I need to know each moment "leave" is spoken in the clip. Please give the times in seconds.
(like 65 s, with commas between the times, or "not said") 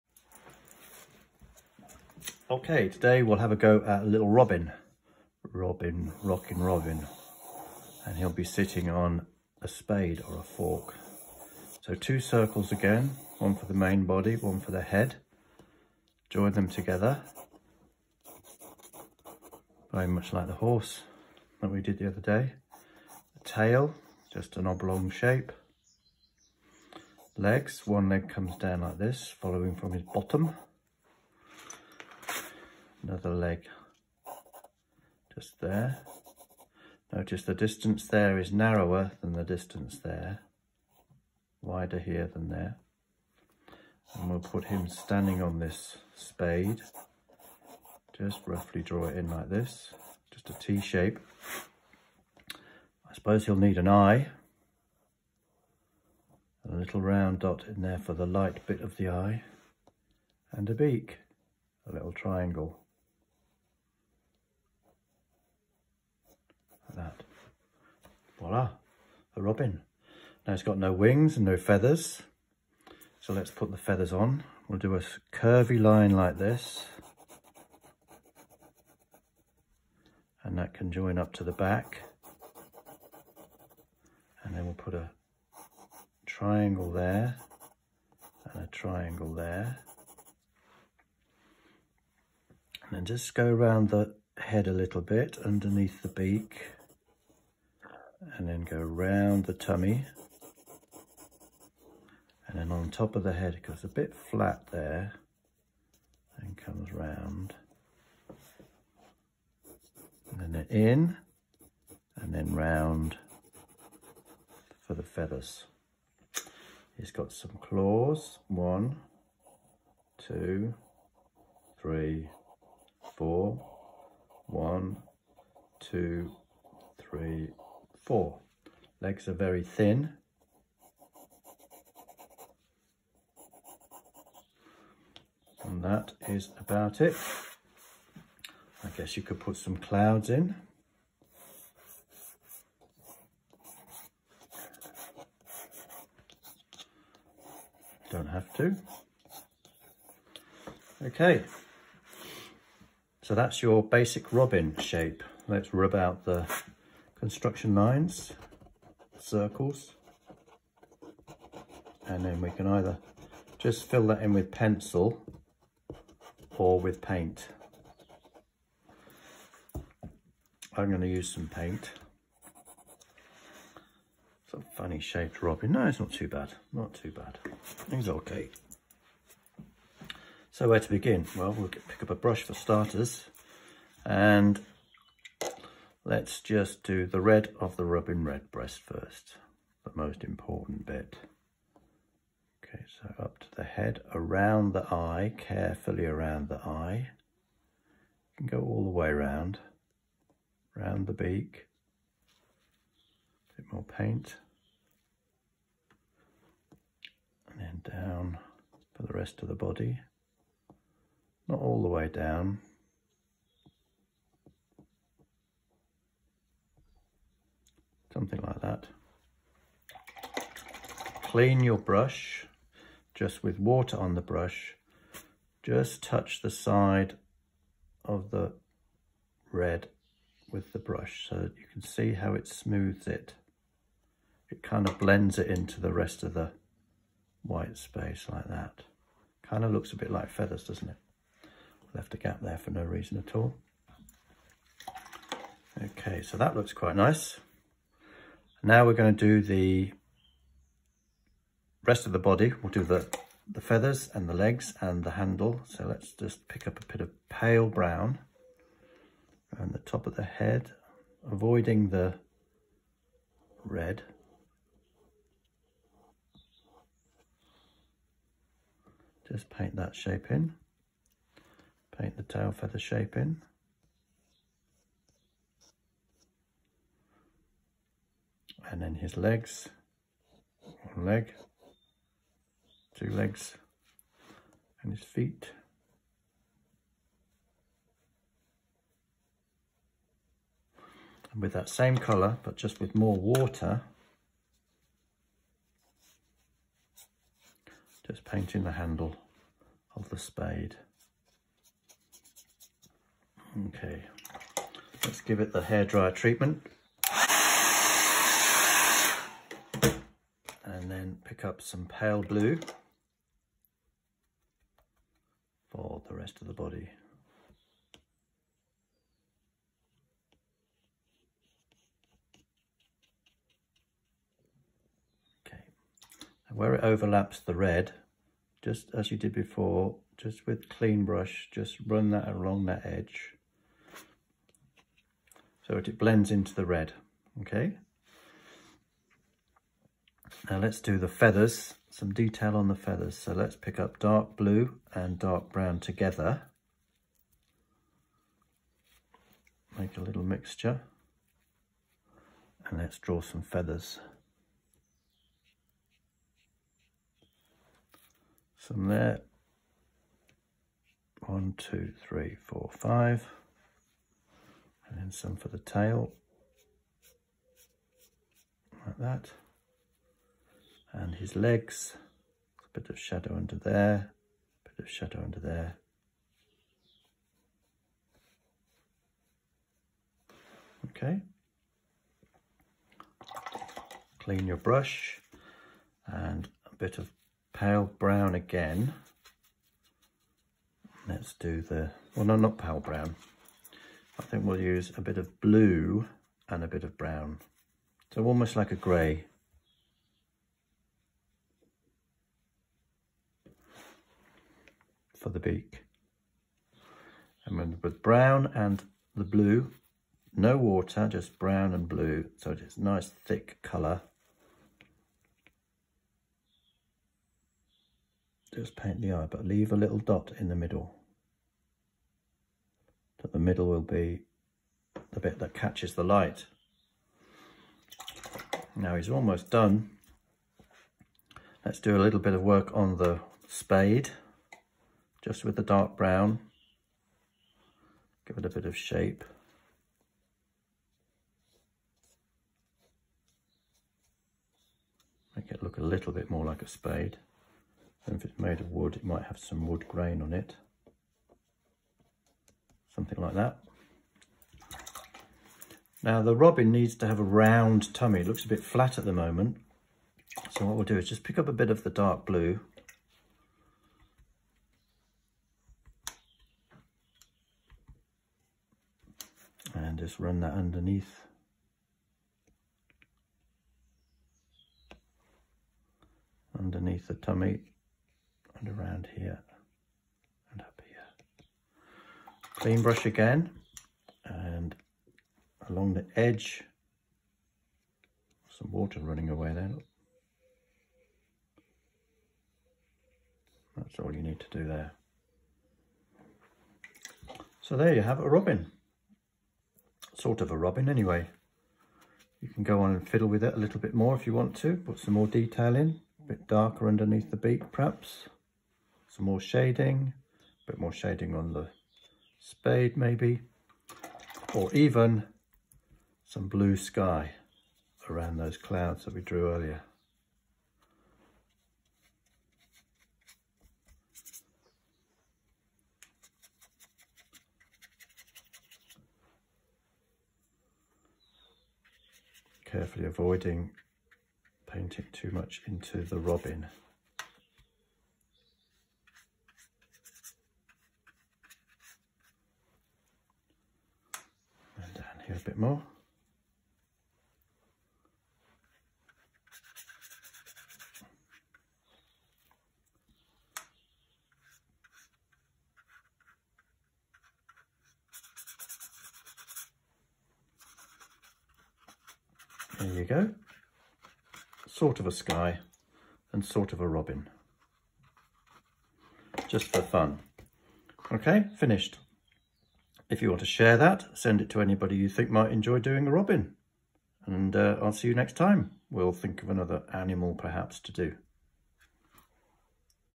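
419 s.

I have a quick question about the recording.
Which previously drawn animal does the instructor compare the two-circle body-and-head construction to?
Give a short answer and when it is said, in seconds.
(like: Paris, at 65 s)
horse, at 20 s.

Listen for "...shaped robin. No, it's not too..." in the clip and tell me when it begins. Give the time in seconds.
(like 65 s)
174 s.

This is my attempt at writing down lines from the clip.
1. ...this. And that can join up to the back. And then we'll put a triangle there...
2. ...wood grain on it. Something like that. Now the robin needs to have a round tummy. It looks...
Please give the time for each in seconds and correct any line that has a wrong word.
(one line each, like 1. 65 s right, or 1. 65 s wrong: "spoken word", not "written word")
1. 76 s right
2. 449 s right.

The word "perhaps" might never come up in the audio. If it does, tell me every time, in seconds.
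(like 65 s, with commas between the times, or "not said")
507 s, 580 s.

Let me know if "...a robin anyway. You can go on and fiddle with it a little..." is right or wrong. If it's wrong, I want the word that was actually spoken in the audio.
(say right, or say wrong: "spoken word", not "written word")
right.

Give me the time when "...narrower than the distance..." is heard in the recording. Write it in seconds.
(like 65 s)
38 s.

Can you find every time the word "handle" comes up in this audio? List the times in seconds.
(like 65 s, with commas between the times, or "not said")
255 s, 298 s.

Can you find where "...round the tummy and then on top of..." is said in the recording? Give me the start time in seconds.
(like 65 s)
98 s.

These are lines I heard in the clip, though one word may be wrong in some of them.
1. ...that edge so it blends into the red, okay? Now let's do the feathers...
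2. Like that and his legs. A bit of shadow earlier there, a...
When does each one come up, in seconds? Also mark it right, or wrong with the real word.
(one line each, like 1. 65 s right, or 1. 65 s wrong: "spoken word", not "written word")
1. 332 s right
2. 368 s wrong: "under", not "earlier".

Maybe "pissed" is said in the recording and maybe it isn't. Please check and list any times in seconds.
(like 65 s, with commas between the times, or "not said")
not said.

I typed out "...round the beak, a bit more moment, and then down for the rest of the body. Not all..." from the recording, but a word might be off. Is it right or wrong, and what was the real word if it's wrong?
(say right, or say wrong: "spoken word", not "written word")
wrong: "paint", not "moment".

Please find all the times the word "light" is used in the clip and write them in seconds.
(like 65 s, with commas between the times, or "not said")
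58 s, 426 s.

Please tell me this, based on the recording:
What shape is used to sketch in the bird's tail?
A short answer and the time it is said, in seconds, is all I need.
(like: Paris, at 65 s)
oblong, at 24 s.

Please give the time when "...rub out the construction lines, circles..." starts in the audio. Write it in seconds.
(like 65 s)
155 s.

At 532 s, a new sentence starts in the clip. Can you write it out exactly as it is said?
carefully avoiding painting too much into the robin.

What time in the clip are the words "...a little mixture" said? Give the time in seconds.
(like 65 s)
349 s.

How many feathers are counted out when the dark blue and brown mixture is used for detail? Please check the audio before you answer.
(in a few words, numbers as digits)
5.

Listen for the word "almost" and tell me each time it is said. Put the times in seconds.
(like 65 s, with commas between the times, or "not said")
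398 s, 429 s.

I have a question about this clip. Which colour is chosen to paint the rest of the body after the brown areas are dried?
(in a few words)
pale blue.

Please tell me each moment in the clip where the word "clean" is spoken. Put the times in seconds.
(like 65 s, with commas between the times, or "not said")
221 s, 330 s, 384 s, 482 s.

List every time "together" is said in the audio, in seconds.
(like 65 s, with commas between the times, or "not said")
16 s, 345 s.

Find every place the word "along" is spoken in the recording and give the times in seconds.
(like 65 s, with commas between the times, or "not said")
332 s, 485 s.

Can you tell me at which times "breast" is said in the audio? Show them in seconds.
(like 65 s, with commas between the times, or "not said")
188 s.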